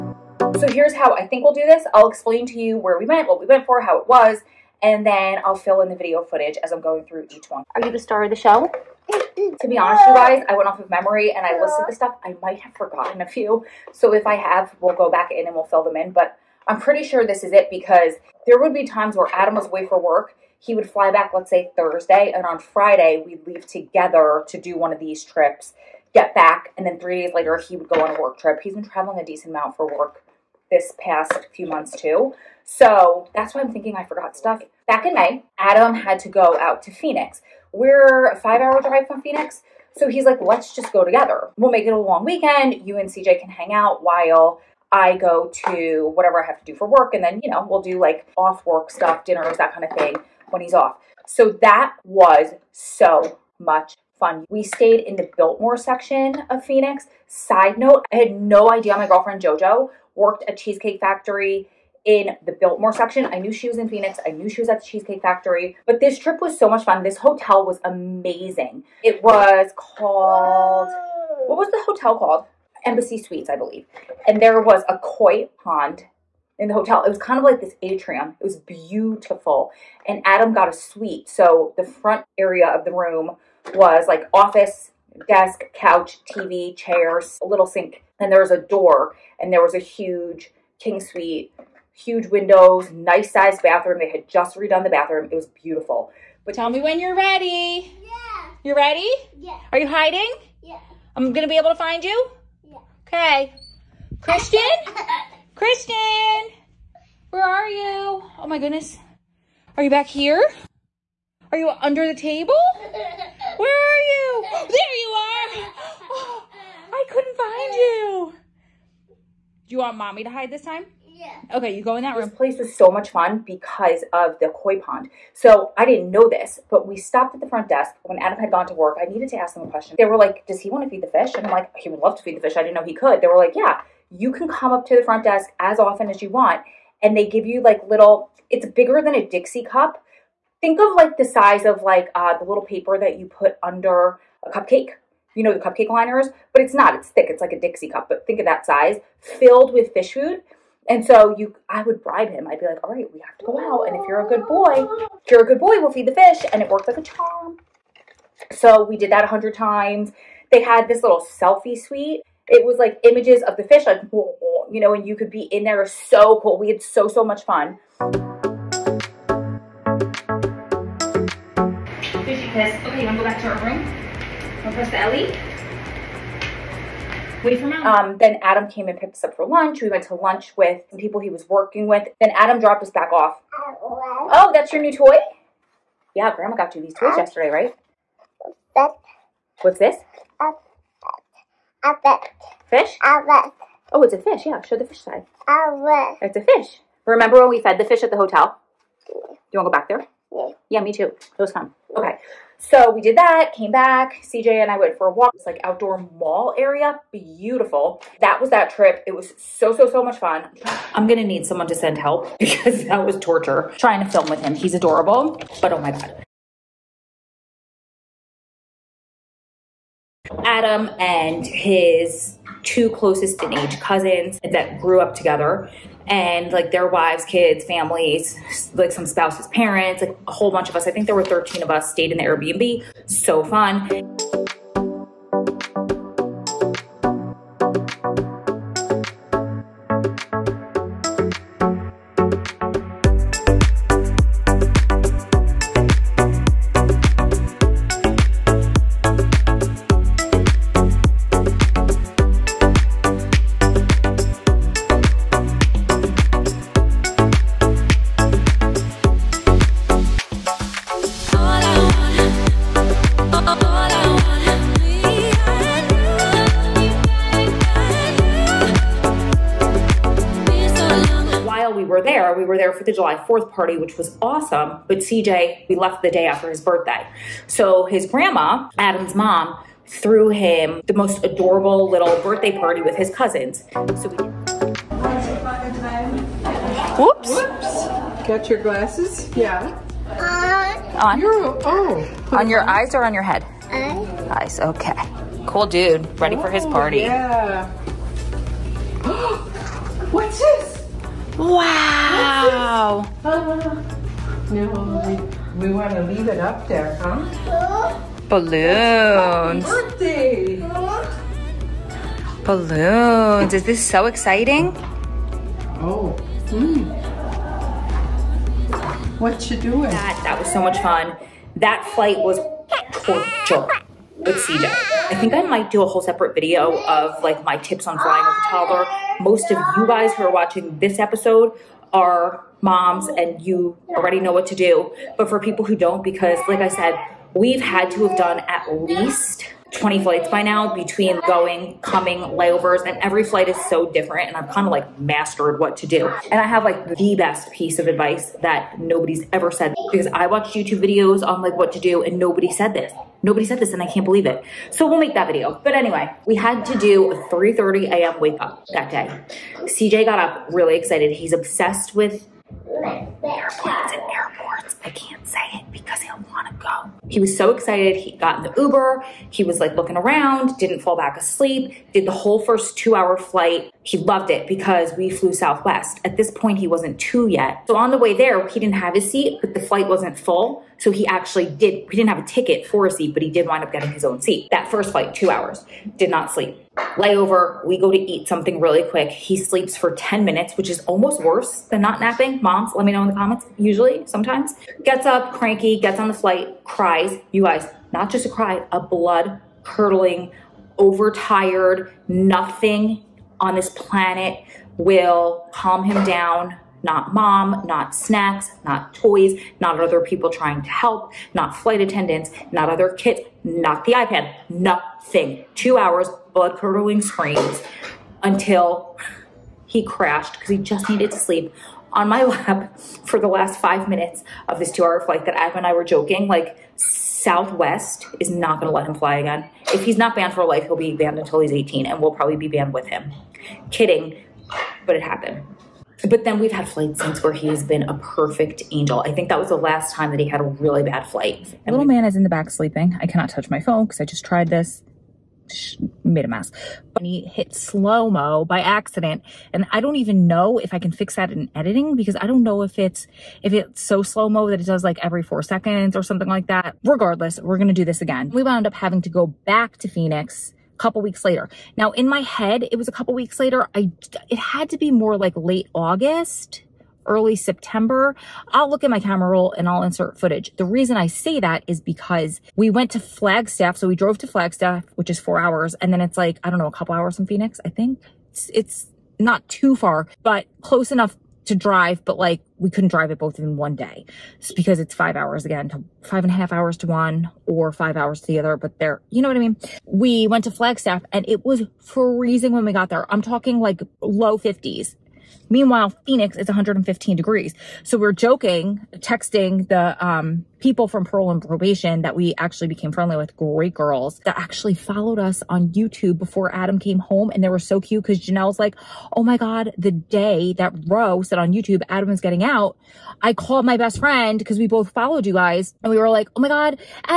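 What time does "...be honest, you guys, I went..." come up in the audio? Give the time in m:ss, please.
0:09.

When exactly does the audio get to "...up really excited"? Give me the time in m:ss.
6:00.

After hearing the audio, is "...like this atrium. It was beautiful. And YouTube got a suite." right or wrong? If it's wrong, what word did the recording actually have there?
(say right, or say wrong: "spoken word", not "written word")
wrong: "Adam", not "YouTube".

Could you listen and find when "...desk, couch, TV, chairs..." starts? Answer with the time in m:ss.
1:25.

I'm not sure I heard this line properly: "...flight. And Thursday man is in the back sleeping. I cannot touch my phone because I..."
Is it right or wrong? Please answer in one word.
wrong.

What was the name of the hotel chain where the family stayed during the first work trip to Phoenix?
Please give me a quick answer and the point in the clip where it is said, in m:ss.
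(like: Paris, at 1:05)
Embassy Suites, at 1:12.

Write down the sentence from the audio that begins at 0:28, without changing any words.
He's been traveling a decent amount for work this past few months too.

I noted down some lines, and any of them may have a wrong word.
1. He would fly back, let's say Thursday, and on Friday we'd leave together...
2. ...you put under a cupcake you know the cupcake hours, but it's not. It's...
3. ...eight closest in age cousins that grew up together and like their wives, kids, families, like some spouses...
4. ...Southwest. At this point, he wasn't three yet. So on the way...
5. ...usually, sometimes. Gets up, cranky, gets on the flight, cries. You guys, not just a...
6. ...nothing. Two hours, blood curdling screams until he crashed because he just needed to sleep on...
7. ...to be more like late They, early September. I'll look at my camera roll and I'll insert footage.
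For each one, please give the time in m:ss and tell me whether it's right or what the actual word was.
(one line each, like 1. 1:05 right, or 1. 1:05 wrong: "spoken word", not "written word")
1. 0:20 right
2. 2:23 wrong: "liners", not "hours"
3. 3:42 wrong: "two", not "eight"
4. 6:15 wrong: "two", not "three"
5. 6:33 right
6. 6:54 right
7. 7:44 wrong: "August", not "They".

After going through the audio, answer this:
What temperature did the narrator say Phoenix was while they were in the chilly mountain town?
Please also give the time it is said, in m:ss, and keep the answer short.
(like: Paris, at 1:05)
115 degrees, at 8:16.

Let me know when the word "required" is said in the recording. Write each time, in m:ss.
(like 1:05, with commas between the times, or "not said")
not said.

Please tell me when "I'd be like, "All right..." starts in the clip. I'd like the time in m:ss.
2:32.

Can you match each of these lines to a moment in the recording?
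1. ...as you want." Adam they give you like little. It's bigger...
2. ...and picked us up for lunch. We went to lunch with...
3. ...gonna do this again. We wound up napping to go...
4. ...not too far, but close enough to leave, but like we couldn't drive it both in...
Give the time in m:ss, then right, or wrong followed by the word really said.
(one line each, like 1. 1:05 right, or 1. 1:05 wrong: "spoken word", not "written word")
1. 2:16 wrong: "And", not "Adam"
2. 2:58 right
3. 7:37 wrong: "having", not "napping"
4. 7:59 wrong: "drive", not "leave".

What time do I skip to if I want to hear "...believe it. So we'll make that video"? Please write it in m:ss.
5:54.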